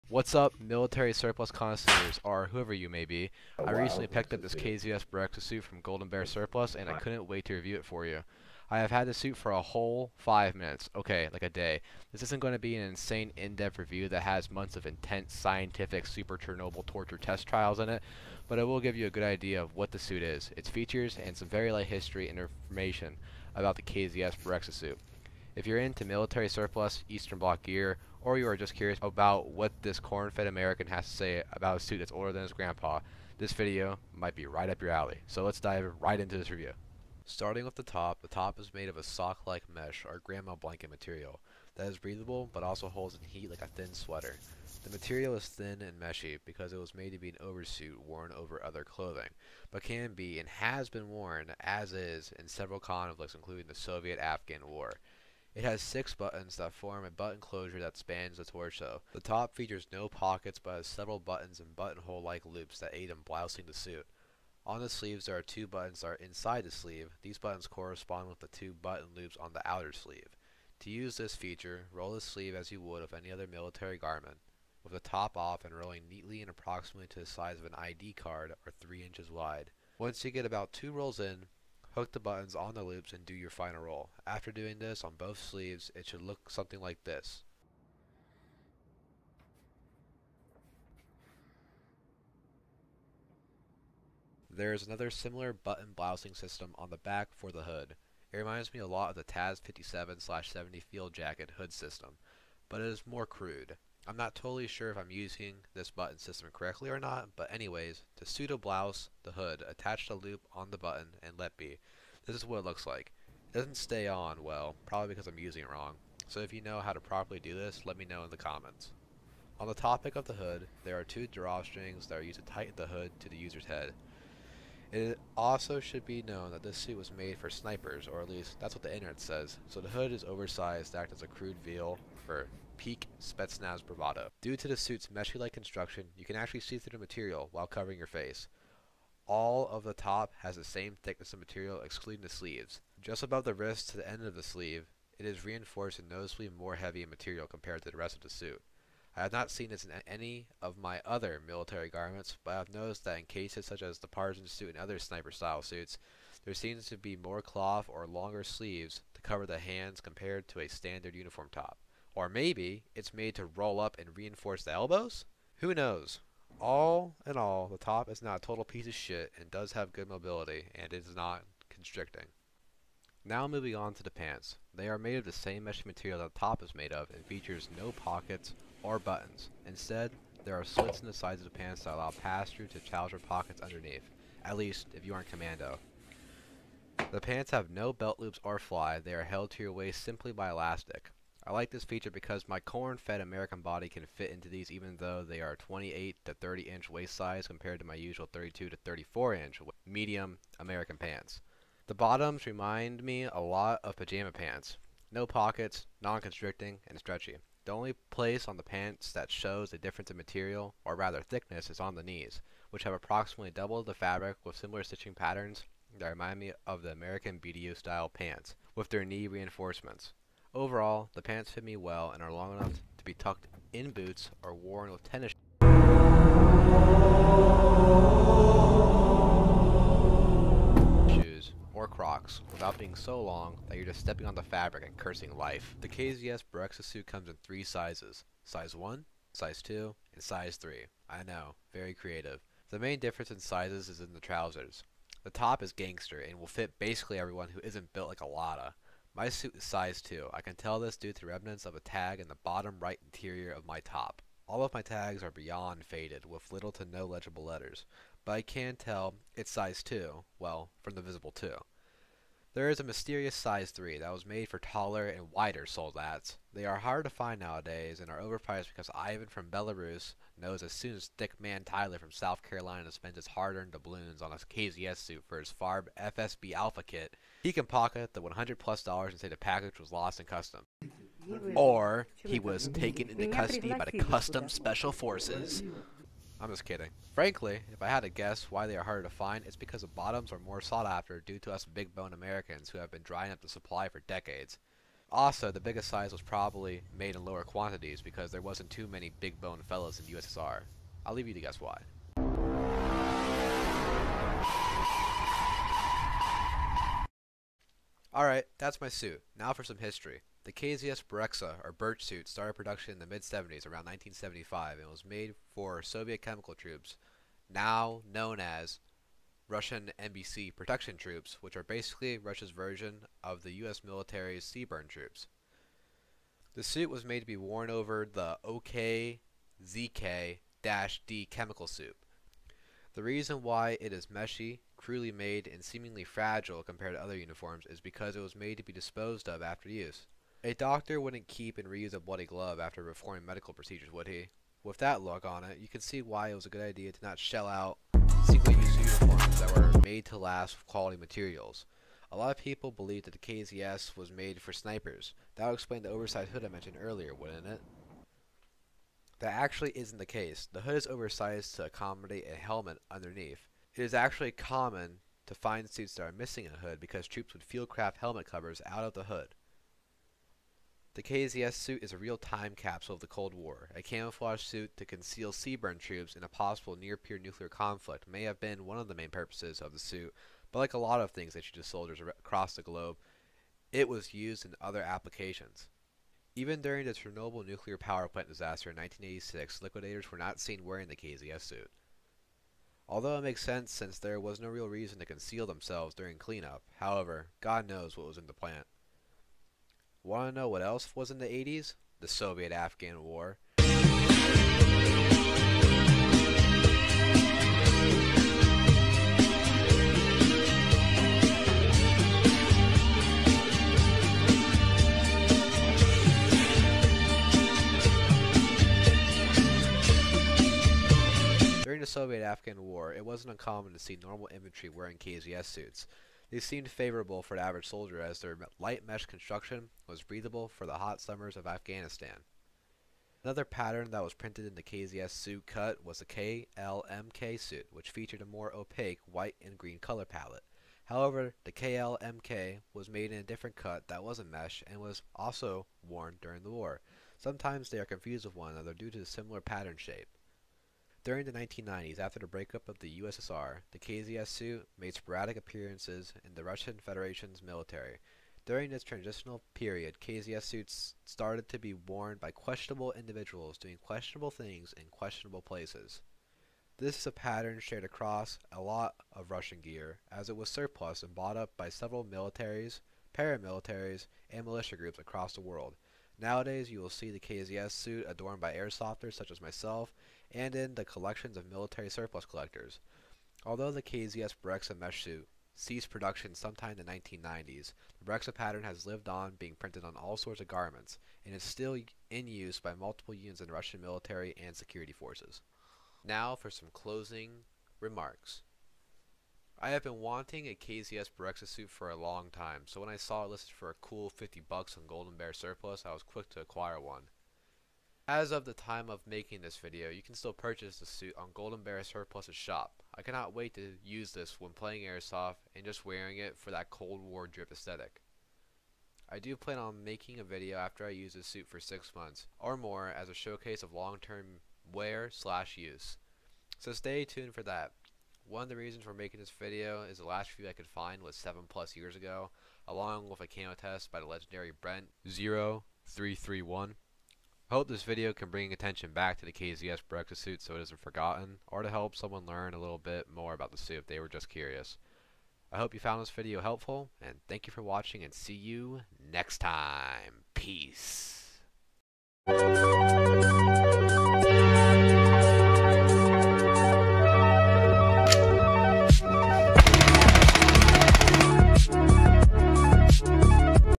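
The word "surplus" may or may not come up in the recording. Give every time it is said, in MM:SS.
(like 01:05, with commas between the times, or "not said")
00:01, 00:06, 00:26, 07:50, 08:01, 08:25, 08:31.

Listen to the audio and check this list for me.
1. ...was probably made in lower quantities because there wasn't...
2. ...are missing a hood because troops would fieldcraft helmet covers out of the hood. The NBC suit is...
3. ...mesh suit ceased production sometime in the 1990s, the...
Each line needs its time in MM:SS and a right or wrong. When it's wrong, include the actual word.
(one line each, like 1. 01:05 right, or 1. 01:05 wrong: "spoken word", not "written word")
1. 04:56 right
2. 06:06 wrong: "KZS", not "NBC"
3. 08:04 right.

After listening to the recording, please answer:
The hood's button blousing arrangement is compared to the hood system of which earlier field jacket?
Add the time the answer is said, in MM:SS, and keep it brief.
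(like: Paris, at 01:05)
Taz 57-70, at 01:39.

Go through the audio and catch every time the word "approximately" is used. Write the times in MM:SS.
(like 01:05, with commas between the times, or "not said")
01:16, 03:32.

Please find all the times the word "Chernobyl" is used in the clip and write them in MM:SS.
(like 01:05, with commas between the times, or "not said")
00:16, 06:26.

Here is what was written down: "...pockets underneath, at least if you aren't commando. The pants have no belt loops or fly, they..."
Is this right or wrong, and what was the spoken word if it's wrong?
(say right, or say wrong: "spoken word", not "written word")
right.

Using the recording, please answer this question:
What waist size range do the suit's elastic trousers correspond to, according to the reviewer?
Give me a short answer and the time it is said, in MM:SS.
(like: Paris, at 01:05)
28 to 30 inch, at 03:15.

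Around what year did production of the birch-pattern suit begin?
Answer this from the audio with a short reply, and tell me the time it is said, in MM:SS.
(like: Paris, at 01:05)
1975, at 05:13.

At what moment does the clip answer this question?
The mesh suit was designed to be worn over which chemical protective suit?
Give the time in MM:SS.
05:28.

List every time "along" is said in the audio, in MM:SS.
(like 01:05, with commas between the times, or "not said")
08:52.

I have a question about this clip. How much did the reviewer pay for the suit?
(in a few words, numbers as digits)
$50.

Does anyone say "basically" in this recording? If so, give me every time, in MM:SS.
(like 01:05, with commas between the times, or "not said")
04:06, 05:21.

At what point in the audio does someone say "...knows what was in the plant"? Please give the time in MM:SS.
06:37.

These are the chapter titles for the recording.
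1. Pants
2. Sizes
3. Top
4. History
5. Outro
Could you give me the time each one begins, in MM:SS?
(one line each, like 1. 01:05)
1. 02:53
2. 03:56
3. 00:37
4. 05:08
5. 08:16.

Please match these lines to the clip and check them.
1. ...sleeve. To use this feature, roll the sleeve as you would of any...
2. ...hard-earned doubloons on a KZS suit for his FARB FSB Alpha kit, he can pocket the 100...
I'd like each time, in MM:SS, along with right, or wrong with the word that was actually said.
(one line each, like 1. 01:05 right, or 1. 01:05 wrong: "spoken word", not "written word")
1. 01:09 right
2. 04:33 right.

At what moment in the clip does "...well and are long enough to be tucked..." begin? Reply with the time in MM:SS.
03:41.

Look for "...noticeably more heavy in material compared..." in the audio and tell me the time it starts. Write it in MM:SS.
02:26.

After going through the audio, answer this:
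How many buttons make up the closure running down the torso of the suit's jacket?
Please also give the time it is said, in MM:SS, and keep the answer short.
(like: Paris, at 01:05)
6, at 00:55.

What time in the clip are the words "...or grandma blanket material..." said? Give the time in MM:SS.
00:40.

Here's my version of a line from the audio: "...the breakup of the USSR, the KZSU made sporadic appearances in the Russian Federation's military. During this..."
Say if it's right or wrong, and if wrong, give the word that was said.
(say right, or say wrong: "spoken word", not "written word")
right.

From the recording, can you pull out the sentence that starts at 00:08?
I have had the suit for a whole five minutes.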